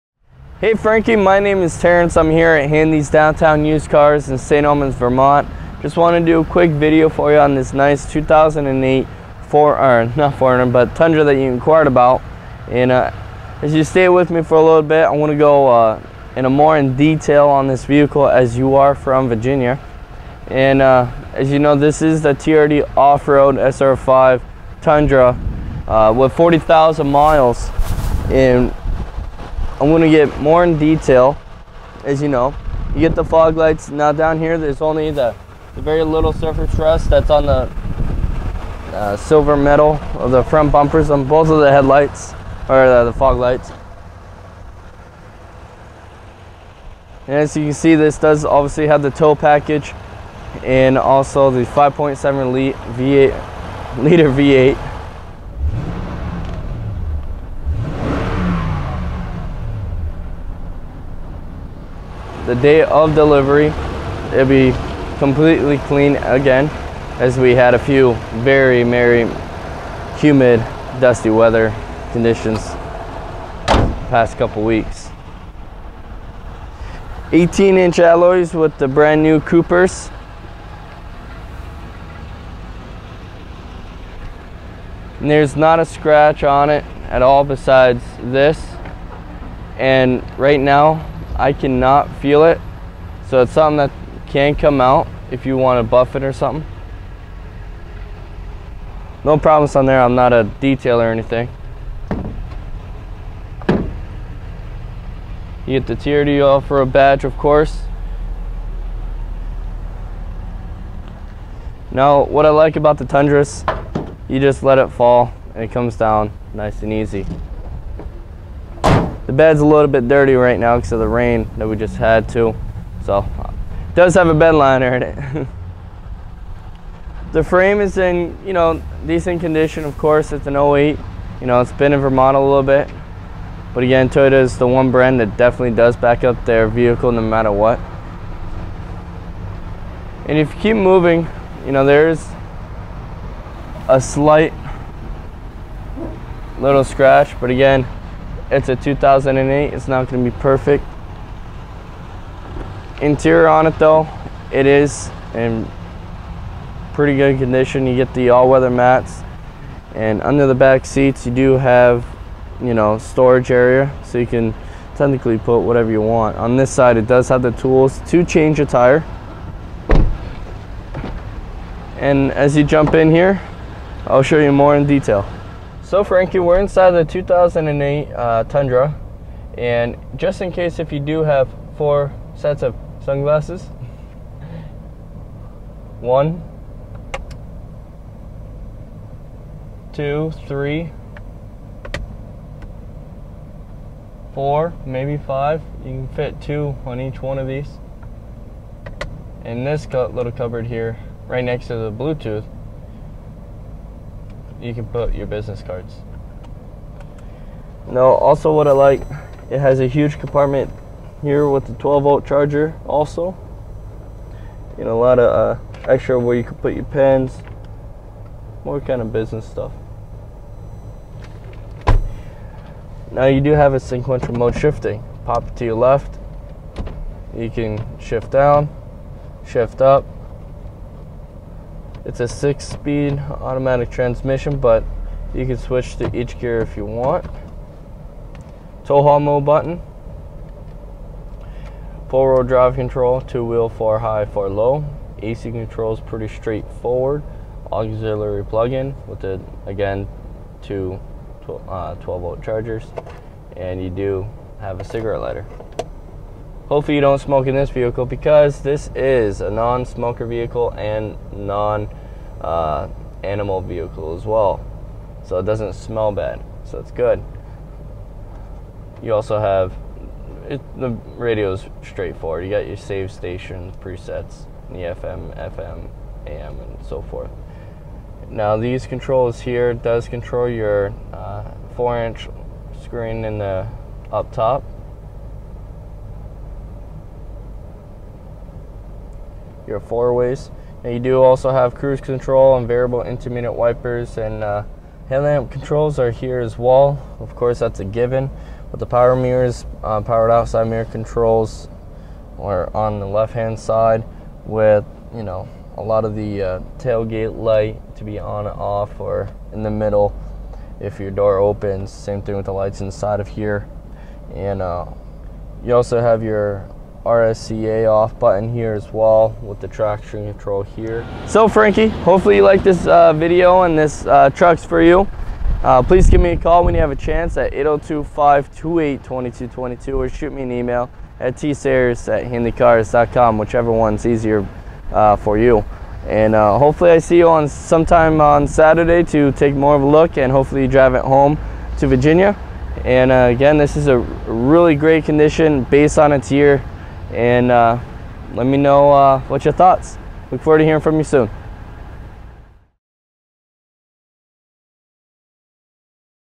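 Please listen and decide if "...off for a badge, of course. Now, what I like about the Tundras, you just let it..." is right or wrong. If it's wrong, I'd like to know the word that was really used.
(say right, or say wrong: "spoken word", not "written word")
right.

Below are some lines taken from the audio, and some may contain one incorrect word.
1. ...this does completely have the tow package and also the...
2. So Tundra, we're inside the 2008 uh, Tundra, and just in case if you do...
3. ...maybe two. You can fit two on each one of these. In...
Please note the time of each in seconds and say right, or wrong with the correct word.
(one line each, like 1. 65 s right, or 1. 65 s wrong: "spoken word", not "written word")
1. 47 s wrong: "obviously", not "completely"
2. 175 s wrong: "Frankie", not "Tundra"
3. 194 s wrong: "five", not "two".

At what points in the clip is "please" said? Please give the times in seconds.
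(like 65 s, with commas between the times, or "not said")
325 s.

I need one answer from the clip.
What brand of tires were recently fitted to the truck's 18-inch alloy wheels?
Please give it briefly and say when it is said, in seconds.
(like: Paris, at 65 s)
Coopers, at 79 s.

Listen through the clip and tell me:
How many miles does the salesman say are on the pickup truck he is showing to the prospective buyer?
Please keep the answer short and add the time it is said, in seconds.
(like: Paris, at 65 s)
40,000, at 26 s.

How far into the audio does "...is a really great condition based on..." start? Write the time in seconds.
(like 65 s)
343 s.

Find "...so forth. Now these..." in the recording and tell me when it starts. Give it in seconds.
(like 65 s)
276 s.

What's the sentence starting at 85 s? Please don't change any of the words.
And there's not a scratch on it at all besides this.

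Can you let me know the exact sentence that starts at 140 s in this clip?
And if you keep moving, you know, there's a slight little scratch, but again, it's a 2008, it's not gonna be perfect.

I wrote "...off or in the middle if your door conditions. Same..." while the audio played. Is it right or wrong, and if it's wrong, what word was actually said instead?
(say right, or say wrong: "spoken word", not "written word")
wrong: "opens", not "conditions".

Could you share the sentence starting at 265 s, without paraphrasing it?
So it doesn't smell bad, so it's good.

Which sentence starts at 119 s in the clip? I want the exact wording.
The bed's a little bit dirty right now because of the rain that we just had too.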